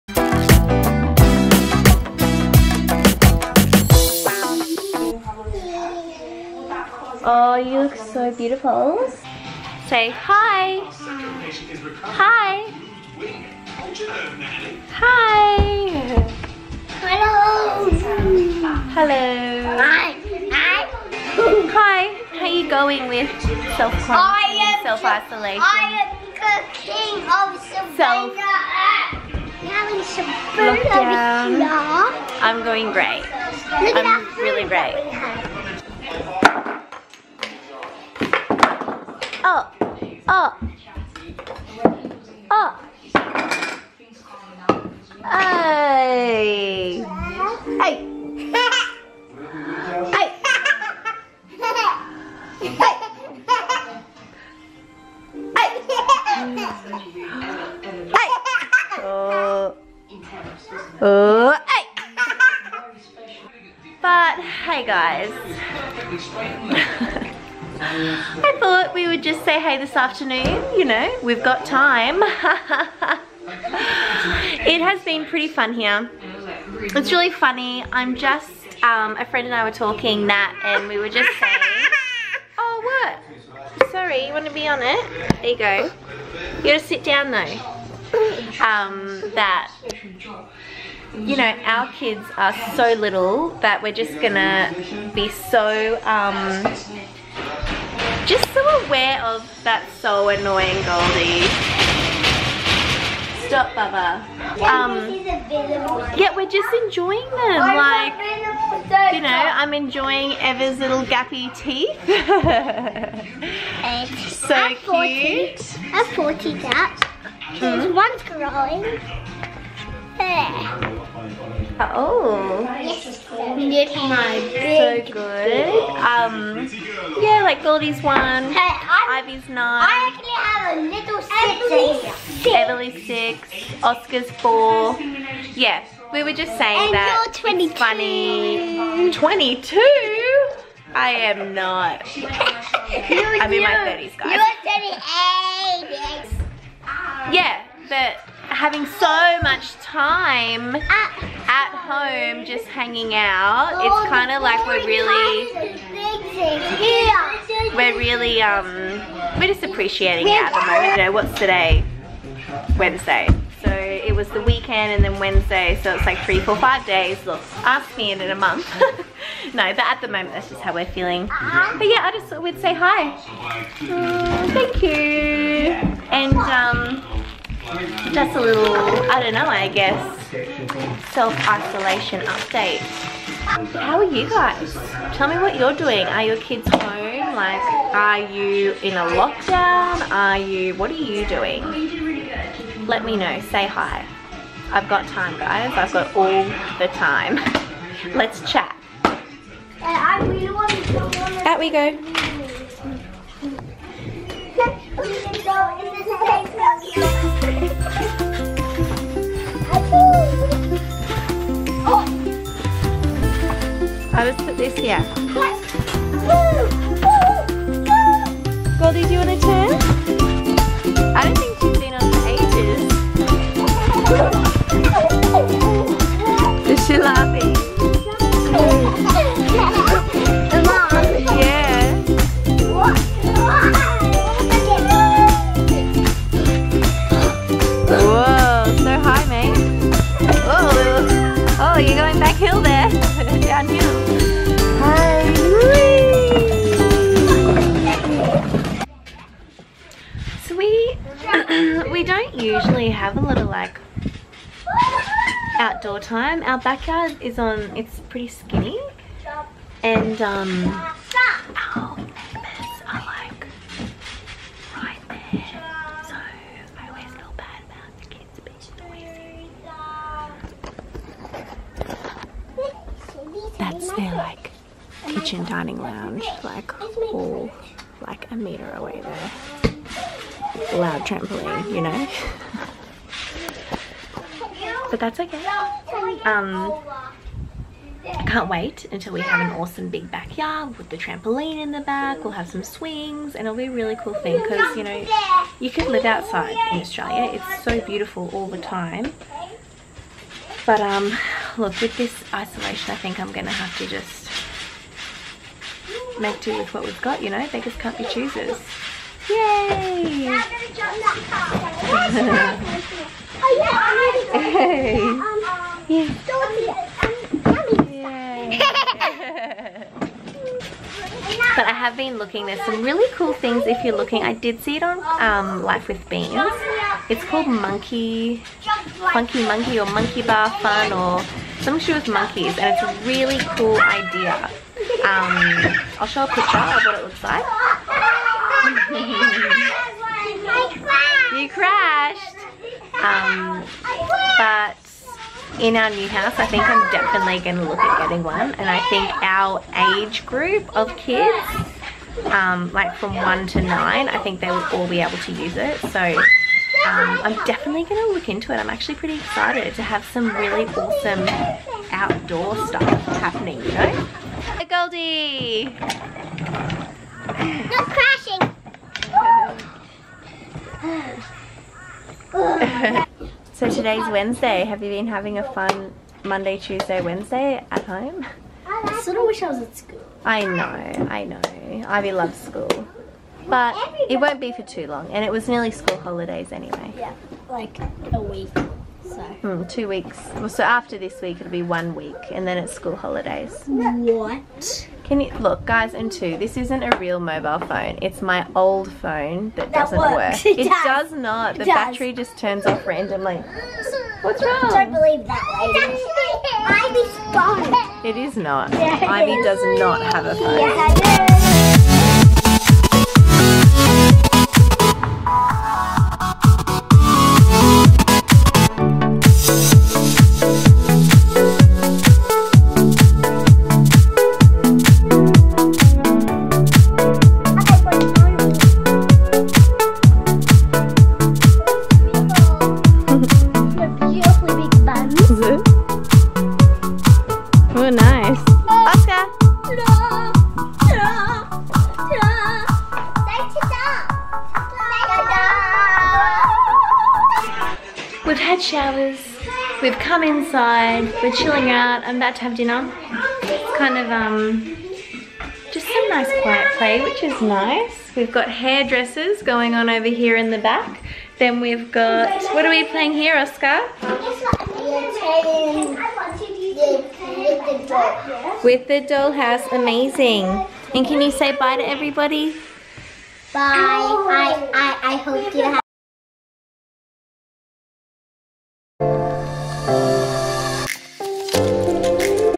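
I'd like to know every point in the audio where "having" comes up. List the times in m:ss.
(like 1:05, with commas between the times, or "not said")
2:28, 6:15.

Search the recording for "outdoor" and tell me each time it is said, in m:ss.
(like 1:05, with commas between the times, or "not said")
4:15, 6:01.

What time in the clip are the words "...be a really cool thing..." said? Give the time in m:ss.
4:53.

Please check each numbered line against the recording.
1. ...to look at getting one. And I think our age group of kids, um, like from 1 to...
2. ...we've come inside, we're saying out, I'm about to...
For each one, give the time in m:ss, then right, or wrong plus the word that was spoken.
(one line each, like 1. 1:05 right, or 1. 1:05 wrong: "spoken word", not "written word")
1. 5:47 right
2. 7:29 wrong: "chilling", not "saying".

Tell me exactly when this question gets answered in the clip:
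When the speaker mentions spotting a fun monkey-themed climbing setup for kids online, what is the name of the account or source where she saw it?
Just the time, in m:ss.
5:25.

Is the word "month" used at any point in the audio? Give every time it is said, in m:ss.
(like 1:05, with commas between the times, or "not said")
2:48.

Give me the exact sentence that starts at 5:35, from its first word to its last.
Um, I'll show a picture of what it looks like.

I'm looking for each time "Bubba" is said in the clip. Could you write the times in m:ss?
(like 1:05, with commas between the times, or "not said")
1:43.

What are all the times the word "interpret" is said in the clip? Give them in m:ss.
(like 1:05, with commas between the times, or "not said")
not said.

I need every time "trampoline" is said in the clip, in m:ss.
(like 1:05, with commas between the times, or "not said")
4:41, 4:50.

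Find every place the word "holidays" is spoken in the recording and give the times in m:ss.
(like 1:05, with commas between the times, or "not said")
6:25, 6:32.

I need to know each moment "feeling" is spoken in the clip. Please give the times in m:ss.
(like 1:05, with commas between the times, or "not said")
2:50.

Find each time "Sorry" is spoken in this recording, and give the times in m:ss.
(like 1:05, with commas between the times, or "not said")
1:23.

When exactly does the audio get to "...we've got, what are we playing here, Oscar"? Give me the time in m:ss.
7:41.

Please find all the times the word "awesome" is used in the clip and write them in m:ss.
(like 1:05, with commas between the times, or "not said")
4:49, 6:00.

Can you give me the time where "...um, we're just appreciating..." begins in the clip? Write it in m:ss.
2:38.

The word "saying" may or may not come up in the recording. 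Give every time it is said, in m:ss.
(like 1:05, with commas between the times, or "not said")
1:21, 2:16.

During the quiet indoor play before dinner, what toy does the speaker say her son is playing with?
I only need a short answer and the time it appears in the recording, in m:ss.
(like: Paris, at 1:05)
Dollhouse, at 7:49.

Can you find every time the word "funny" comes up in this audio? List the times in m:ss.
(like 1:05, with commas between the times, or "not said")
1:17, 2:17.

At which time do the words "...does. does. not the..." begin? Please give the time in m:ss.
6:40.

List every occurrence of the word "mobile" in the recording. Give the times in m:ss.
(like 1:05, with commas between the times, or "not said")
6:37.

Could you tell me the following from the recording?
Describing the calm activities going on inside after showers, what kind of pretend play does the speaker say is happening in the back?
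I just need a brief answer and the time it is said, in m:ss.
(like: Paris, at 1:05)
Hairdressers, at 7:38.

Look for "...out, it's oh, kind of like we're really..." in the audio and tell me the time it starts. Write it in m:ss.
2:33.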